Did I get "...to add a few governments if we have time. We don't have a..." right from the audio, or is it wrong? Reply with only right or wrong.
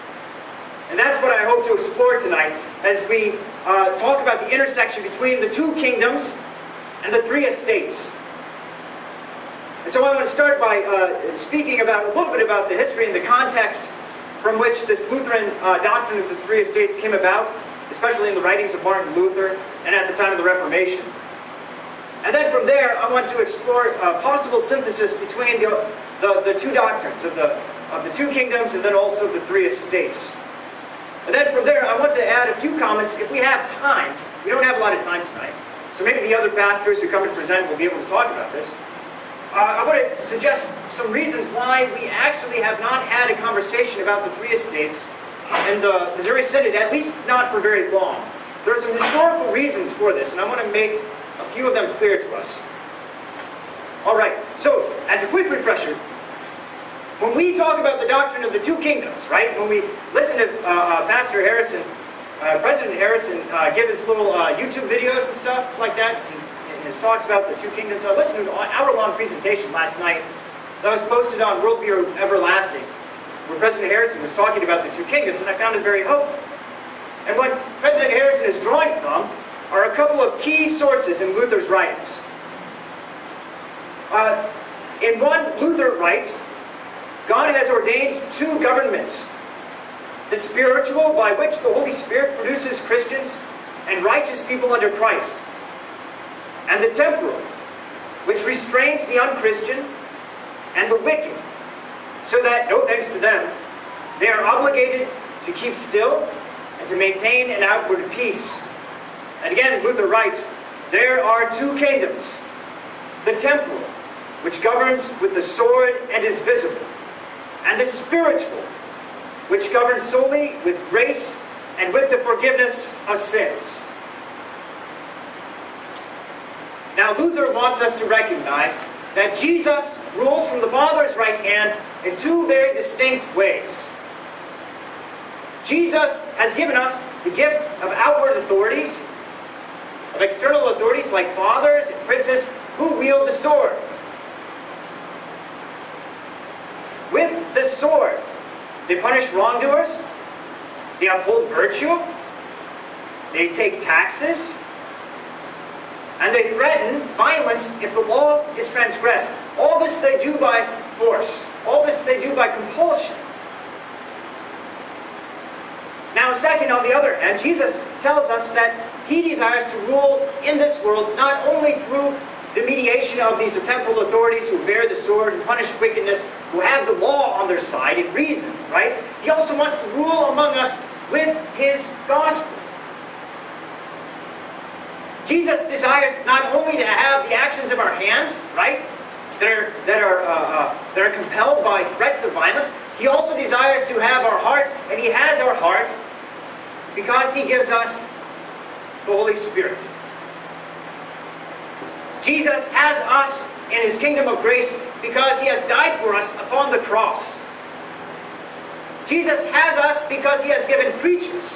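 wrong.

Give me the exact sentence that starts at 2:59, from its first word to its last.
He also wants to rule among us with his gospel.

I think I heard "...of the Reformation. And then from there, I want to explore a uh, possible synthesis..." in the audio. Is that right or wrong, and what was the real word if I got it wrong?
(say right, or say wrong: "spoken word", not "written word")
right.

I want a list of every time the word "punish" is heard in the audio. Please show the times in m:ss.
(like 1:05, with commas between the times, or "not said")
2:28, 2:55.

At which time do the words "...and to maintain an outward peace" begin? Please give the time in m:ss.
1:46.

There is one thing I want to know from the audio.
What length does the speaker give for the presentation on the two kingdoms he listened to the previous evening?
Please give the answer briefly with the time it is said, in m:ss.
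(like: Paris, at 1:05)
hour-long, at 1:08.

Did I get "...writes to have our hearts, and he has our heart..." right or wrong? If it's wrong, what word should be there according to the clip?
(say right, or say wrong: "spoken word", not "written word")
wrong: "desires", not "writes".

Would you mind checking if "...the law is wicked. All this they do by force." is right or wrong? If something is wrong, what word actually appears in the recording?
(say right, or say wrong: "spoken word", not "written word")
wrong: "transgressed", not "wicked".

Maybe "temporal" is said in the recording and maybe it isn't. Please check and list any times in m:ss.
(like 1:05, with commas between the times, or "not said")
1:36, 1:53, 2:53.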